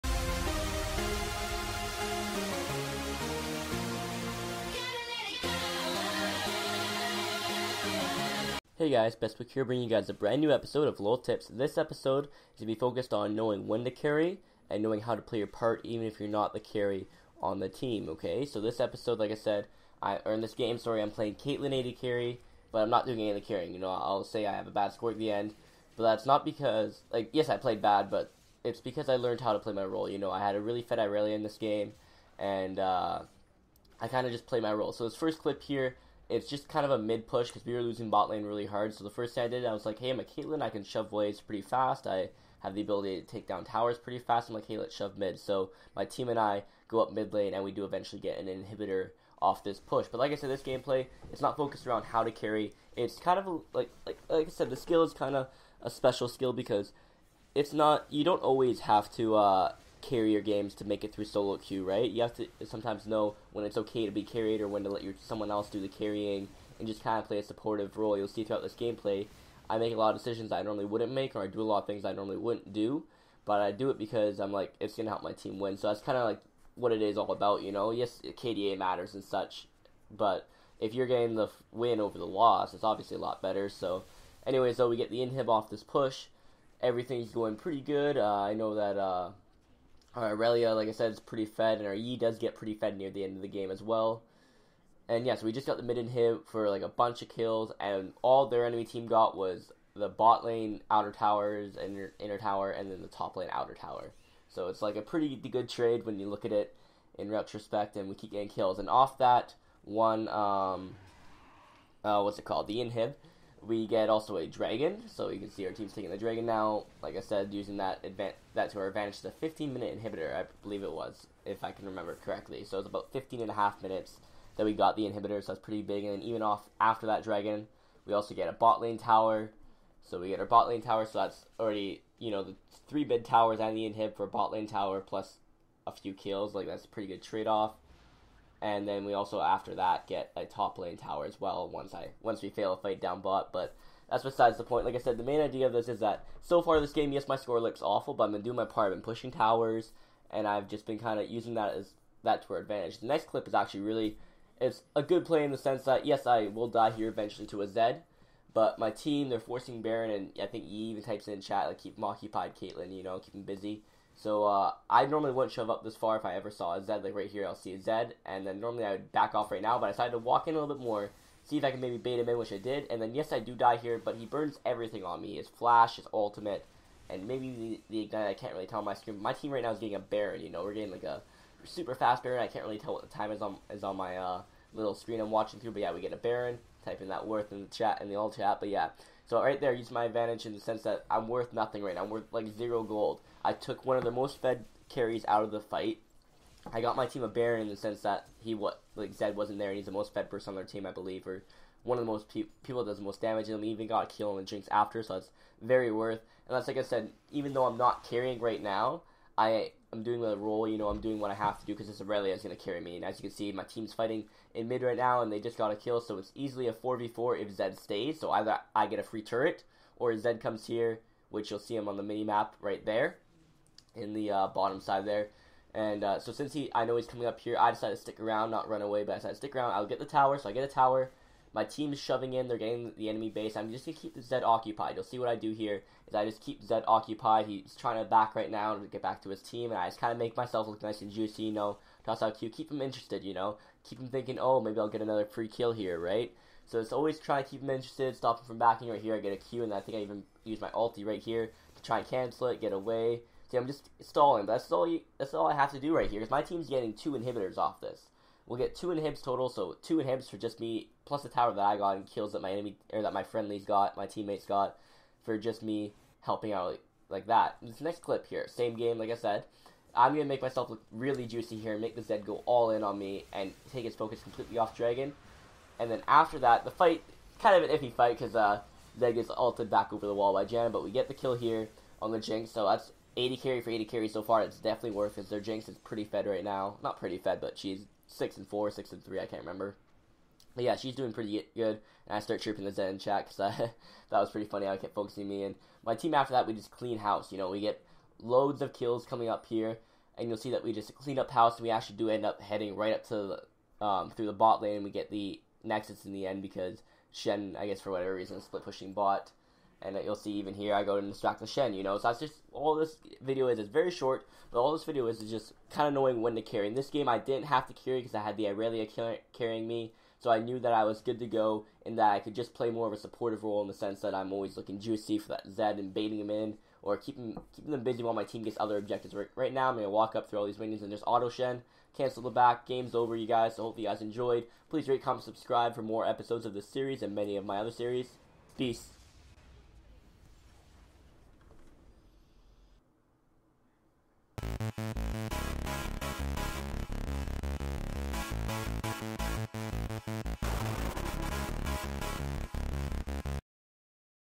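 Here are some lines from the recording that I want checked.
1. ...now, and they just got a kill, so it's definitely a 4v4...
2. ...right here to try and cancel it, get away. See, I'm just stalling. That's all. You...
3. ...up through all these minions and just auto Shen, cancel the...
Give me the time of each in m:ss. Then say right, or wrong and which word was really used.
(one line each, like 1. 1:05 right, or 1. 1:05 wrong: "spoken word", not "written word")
1. 3:34 wrong: "easily", not "definitely"
2. 4:11 right
3. 5:30 right.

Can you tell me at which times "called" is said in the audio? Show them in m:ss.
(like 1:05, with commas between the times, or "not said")
1:52.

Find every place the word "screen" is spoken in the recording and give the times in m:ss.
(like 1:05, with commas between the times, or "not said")
2:58, 3:04.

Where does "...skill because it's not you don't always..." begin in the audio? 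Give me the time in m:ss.
0:56.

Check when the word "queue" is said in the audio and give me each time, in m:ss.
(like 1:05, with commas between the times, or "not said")
1:01.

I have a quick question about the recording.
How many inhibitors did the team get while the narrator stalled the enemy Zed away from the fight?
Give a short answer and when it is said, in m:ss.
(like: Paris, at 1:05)
2, at 4:18.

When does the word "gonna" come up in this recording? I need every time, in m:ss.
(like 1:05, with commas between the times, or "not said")
1:14, 4:30.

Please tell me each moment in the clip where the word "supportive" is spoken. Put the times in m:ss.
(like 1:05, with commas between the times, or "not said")
1:07, 5:22.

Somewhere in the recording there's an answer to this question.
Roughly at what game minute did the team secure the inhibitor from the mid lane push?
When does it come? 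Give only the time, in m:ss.
1:59.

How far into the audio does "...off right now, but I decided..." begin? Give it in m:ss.
2:49.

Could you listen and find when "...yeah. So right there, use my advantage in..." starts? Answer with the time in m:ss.
3:08.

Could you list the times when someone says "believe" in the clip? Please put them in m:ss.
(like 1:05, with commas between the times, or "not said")
2:00, 3:20.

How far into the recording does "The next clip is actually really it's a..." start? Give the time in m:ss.
2:32.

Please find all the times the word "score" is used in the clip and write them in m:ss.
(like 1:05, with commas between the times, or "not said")
0:24, 2:27.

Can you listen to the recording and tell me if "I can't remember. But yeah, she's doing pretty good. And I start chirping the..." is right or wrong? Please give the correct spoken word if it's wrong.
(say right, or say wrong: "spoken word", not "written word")
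right.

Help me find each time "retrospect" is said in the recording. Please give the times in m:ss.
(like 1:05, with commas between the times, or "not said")
1:47.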